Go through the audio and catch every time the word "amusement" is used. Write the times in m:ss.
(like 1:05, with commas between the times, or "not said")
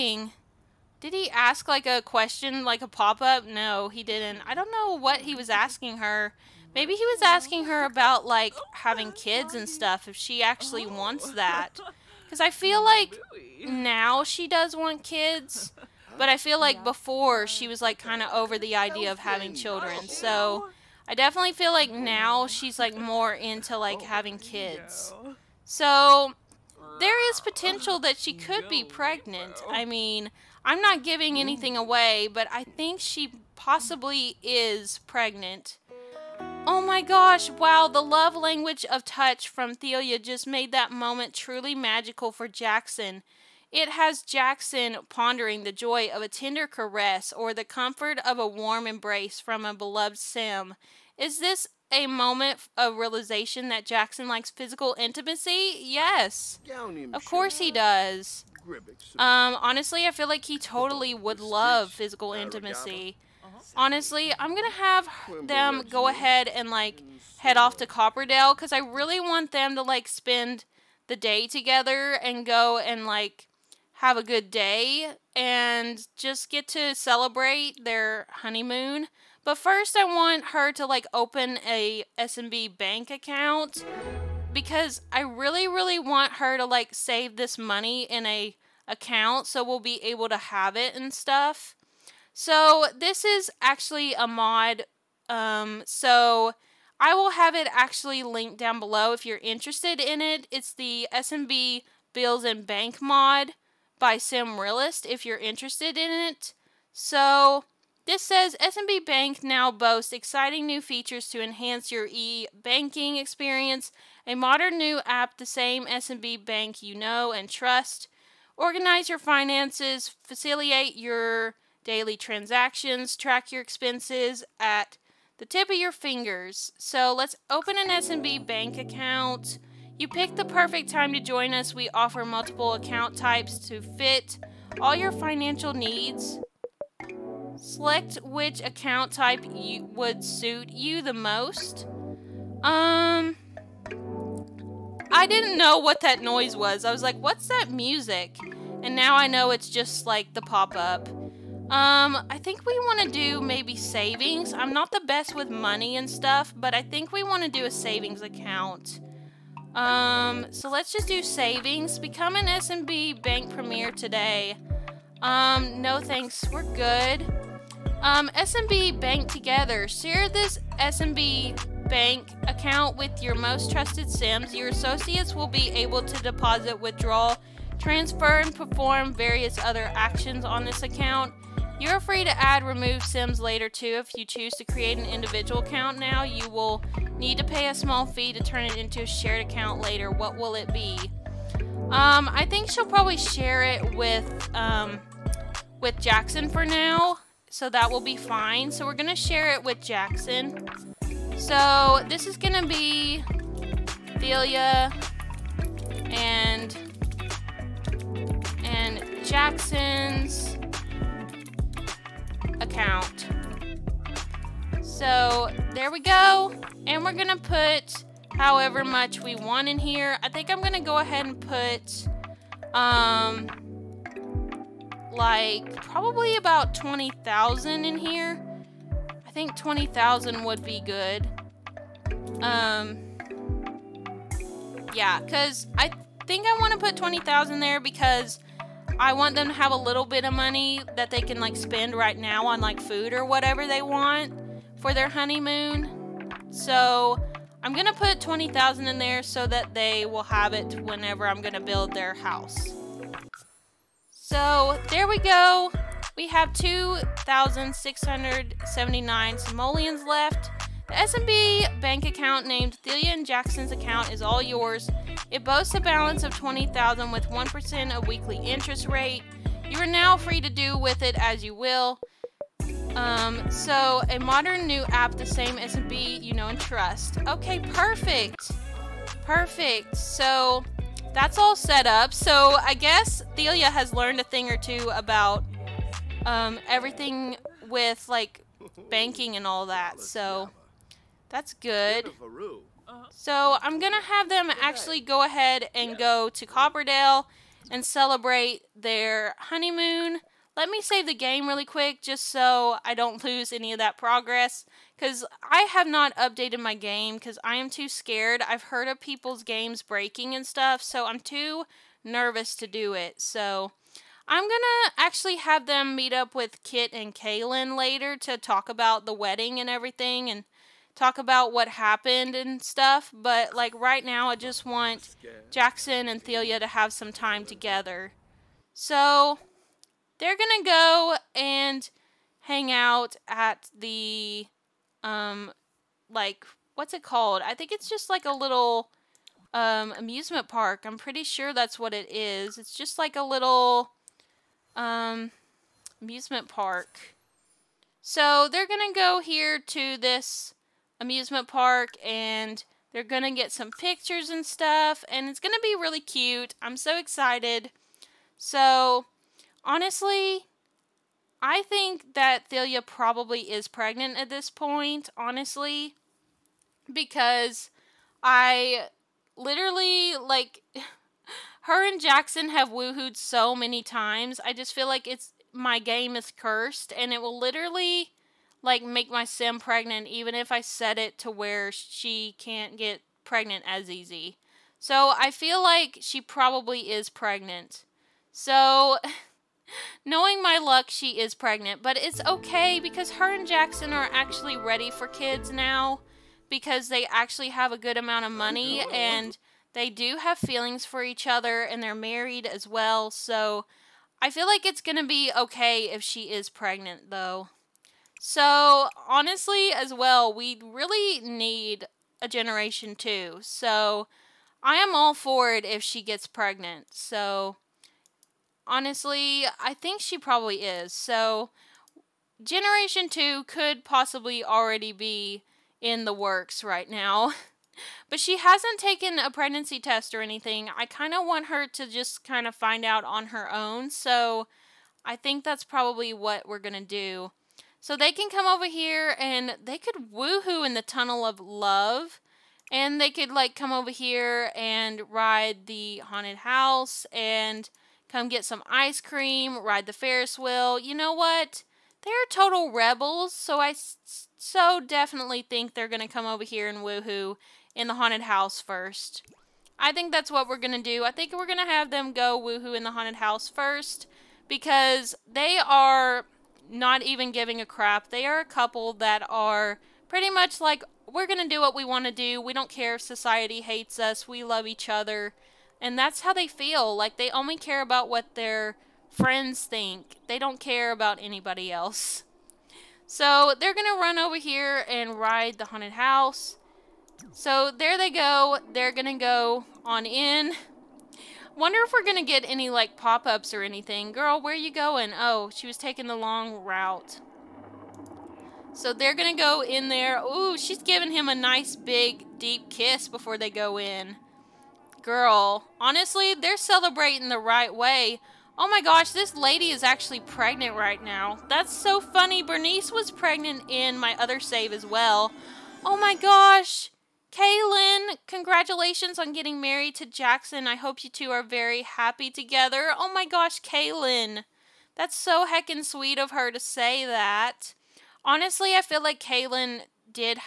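5:39, 5:46, 5:50.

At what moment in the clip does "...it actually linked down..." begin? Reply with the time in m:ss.
1:37.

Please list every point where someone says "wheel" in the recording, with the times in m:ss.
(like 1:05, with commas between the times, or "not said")
7:30.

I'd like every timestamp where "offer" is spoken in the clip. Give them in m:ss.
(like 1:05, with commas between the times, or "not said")
2:11.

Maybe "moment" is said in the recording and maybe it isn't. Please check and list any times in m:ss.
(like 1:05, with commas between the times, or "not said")
0:40, 0:52.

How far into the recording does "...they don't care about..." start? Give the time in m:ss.
8:00.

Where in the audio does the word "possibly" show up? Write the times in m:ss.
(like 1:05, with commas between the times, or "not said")
0:33, 7:03.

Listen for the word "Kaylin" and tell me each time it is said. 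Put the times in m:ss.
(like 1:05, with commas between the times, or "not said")
5:17, 8:37, 8:43, 8:49.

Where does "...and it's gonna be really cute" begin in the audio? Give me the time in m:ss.
5:55.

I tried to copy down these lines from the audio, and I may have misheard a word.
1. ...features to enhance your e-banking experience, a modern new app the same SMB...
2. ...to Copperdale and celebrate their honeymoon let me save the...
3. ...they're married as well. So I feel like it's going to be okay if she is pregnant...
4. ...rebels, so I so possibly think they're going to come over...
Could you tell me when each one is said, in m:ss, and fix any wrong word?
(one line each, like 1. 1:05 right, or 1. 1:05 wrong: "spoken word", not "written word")
1. 1:50 right
2. 4:56 right
3. 6:41 right
4. 7:32 wrong: "definitely", not "possibly".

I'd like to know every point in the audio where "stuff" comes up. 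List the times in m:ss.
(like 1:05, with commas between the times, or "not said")
0:09, 1:31, 2:36, 5:10, 5:22, 5:54.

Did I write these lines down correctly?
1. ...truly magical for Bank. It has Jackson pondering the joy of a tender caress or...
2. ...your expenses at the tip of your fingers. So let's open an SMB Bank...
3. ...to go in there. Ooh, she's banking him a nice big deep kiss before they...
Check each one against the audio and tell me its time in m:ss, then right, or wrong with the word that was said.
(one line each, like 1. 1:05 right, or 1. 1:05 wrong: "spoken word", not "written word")
1. 0:41 wrong: "Jackson", not "Bank"
2. 2:03 right
3. 8:19 wrong: "giving", not "banking".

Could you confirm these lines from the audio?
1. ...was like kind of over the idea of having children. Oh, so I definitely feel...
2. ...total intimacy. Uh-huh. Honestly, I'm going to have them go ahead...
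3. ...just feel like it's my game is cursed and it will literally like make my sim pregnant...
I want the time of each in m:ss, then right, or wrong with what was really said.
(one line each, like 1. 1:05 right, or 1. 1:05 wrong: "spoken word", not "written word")
1. 0:17 right
2. 1:01 wrong: "physical", not "total"
3. 6:14 right.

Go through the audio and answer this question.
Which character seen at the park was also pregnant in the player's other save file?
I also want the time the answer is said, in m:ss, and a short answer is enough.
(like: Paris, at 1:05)
Bernice, at 8:32.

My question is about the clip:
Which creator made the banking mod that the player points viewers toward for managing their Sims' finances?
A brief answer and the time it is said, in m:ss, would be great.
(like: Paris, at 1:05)
Sim Realist, at 1:44.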